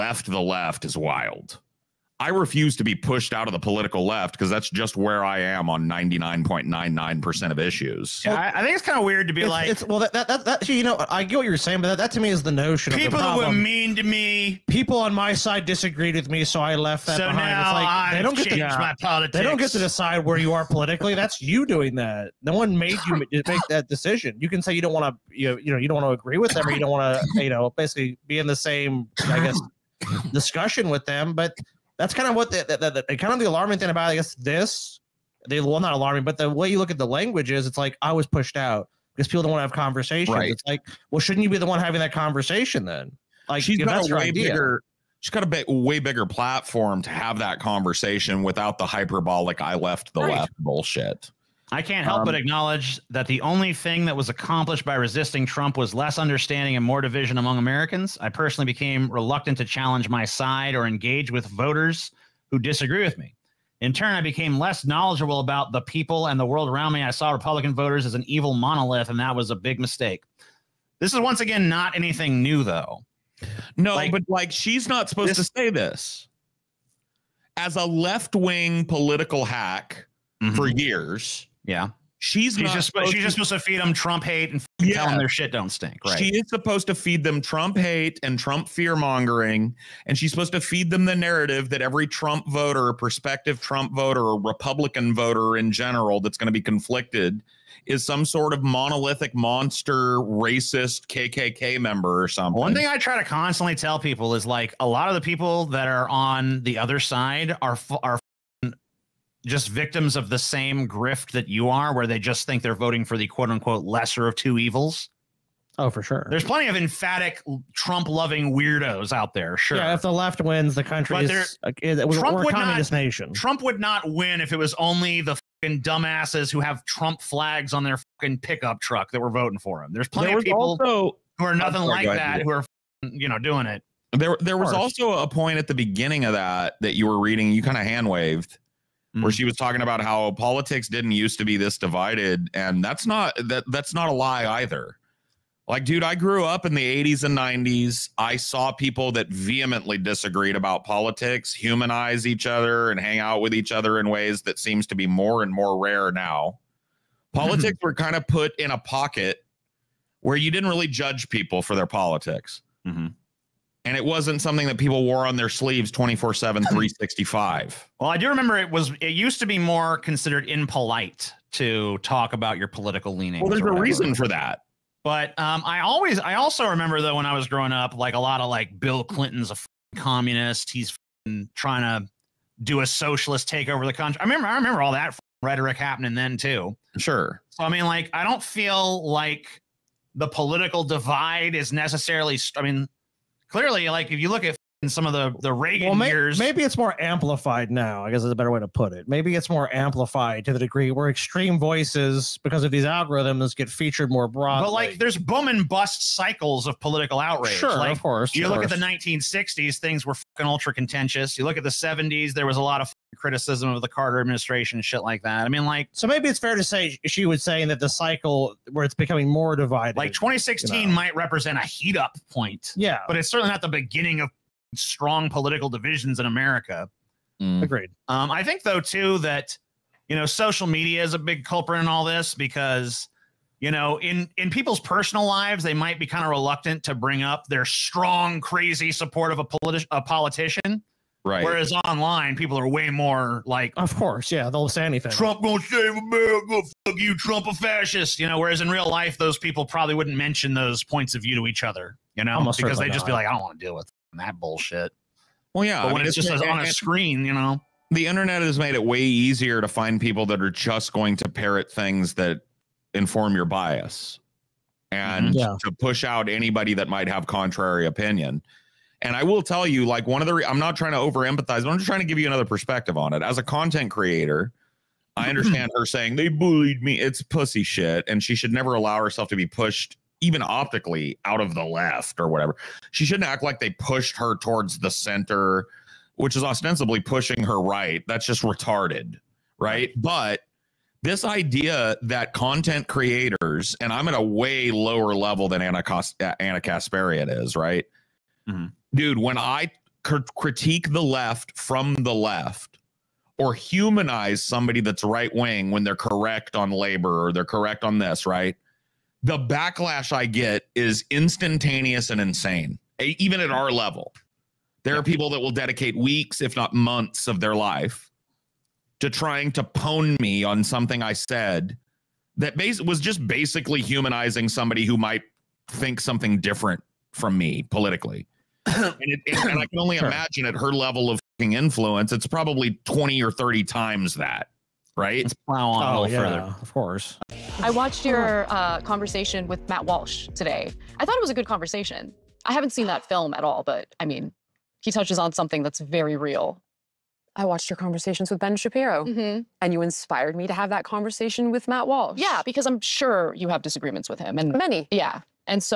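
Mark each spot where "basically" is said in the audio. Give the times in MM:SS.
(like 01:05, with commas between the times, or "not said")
00:27, 05:23.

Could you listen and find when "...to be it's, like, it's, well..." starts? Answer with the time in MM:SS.
00:09.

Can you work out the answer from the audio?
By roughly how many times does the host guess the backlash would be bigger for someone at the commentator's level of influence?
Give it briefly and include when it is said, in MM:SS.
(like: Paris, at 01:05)
20 or 30, at 05:32.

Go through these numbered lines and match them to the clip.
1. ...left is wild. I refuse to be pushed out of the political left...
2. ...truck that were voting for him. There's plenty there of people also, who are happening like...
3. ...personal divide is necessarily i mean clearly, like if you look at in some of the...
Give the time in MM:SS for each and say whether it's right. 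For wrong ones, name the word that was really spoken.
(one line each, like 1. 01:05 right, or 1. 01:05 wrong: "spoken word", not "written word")
1. 00:00 right
2. 02:08 wrong: "nothing", not "happening"
3. 03:10 wrong: "political", not "personal".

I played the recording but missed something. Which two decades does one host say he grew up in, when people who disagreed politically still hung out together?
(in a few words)
80s and 90s.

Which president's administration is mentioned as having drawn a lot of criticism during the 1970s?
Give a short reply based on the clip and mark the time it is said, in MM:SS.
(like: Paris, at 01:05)
Carter, at 03:33.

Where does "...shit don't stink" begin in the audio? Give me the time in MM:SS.
01:25.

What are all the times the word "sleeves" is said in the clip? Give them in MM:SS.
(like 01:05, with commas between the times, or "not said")
02:45.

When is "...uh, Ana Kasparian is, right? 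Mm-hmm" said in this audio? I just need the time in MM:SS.
04:56.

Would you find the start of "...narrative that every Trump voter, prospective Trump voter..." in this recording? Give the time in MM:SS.
01:31.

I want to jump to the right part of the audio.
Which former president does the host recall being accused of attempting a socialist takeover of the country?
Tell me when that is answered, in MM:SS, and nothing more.
02:58.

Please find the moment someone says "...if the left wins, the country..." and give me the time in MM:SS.
01:59.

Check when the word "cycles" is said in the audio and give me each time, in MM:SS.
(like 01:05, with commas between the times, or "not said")
03:26, 03:37.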